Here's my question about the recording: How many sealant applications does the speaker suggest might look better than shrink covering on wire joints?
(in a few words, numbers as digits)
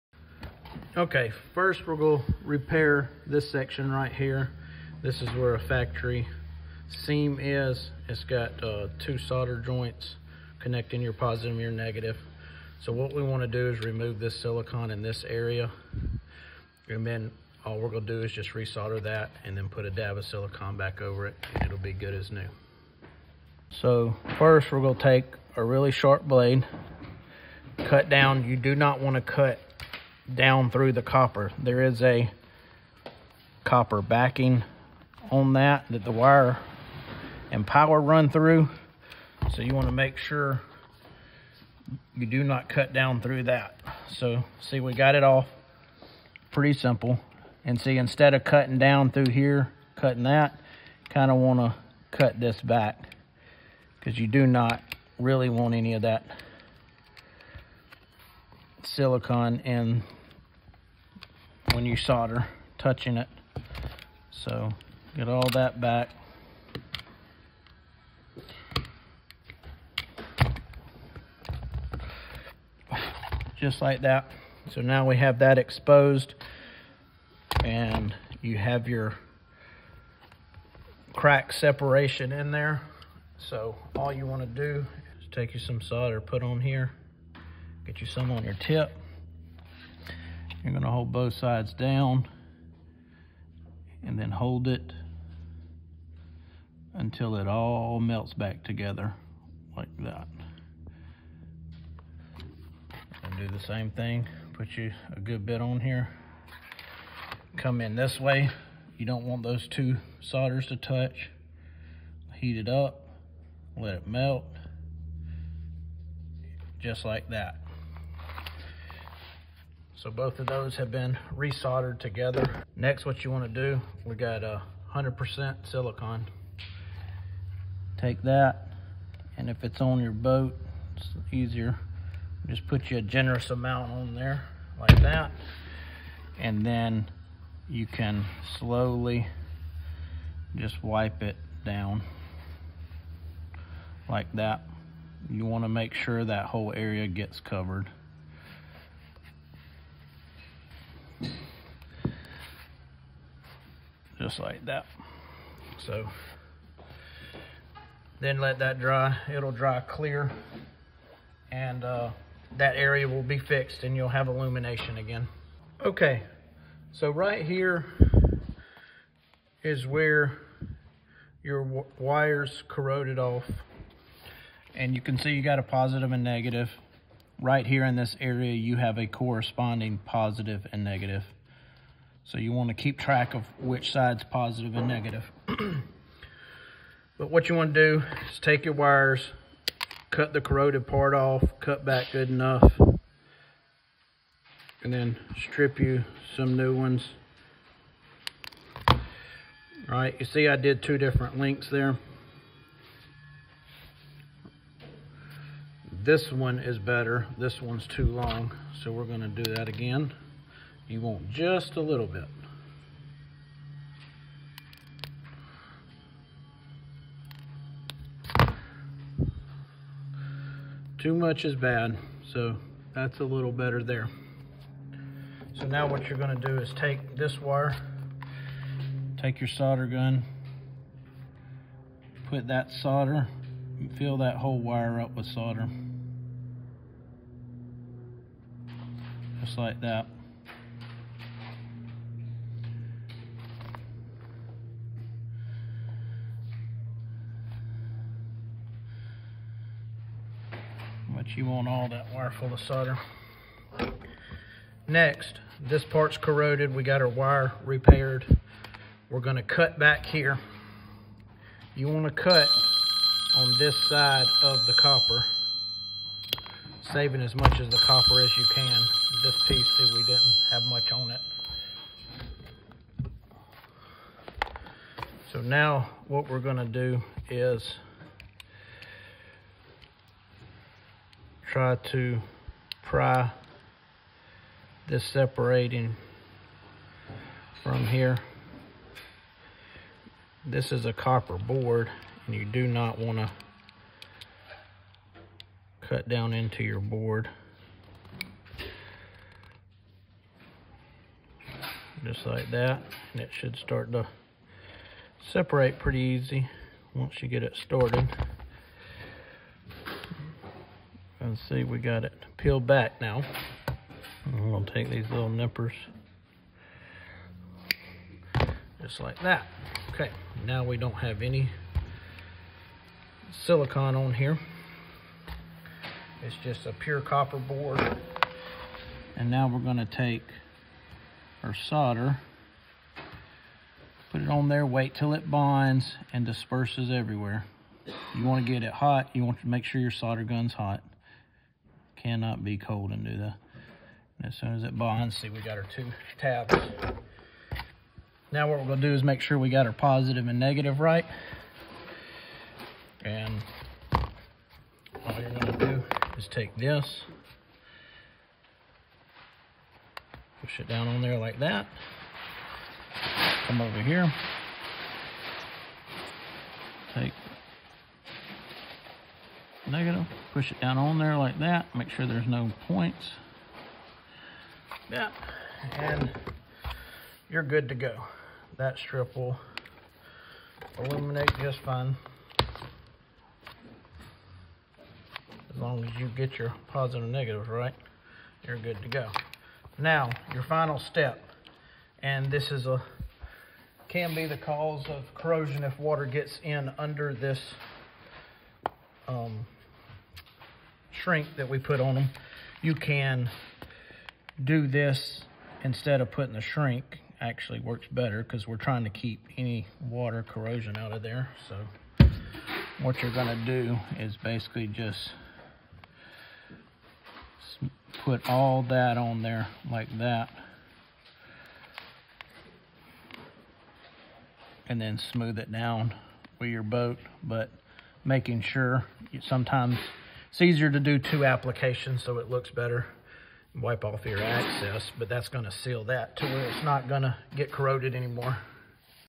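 2.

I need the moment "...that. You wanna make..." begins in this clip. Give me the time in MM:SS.
02:24.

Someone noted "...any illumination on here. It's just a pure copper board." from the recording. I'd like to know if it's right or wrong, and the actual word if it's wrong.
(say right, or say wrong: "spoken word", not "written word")
wrong: "silicon", not "illumination".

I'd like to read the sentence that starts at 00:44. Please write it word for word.
So see, we got it off pretty simple.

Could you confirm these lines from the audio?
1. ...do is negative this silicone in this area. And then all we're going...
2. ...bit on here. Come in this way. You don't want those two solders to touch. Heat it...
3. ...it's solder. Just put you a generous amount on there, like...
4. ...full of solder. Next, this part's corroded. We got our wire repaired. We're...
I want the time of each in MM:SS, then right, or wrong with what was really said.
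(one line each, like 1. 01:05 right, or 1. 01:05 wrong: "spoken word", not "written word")
1. 00:13 wrong: "remove", not "negative"
2. 01:45 right
3. 02:10 wrong: "easier", not "solder"
4. 04:12 right.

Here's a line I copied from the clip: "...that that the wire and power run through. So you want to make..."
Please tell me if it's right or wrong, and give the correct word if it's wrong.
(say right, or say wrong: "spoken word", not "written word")
right.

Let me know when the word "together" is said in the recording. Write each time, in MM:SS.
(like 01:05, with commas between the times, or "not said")
01:38, 02:01.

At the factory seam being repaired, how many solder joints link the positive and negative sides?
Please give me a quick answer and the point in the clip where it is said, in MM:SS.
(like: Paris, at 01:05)
2, at 00:08.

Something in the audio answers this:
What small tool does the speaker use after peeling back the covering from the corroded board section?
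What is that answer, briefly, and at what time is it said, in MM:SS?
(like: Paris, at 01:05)
Nippers, at 05:15.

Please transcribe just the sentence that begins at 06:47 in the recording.
Actually works better because we're trying to keep any water corrosion out of there.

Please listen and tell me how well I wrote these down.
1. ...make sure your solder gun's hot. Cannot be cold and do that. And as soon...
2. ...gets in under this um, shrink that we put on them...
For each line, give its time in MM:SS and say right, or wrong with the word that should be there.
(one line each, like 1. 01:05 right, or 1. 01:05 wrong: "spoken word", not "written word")
1. 05:39 right
2. 06:36 right.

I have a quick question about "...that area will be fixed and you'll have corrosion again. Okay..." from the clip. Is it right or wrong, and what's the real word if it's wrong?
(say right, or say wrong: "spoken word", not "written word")
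wrong: "illumination", not "corrosion".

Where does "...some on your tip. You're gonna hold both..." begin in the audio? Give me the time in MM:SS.
01:28.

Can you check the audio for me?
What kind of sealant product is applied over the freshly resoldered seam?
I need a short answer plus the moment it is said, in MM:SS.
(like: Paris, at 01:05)
100% silicone, at 02:04.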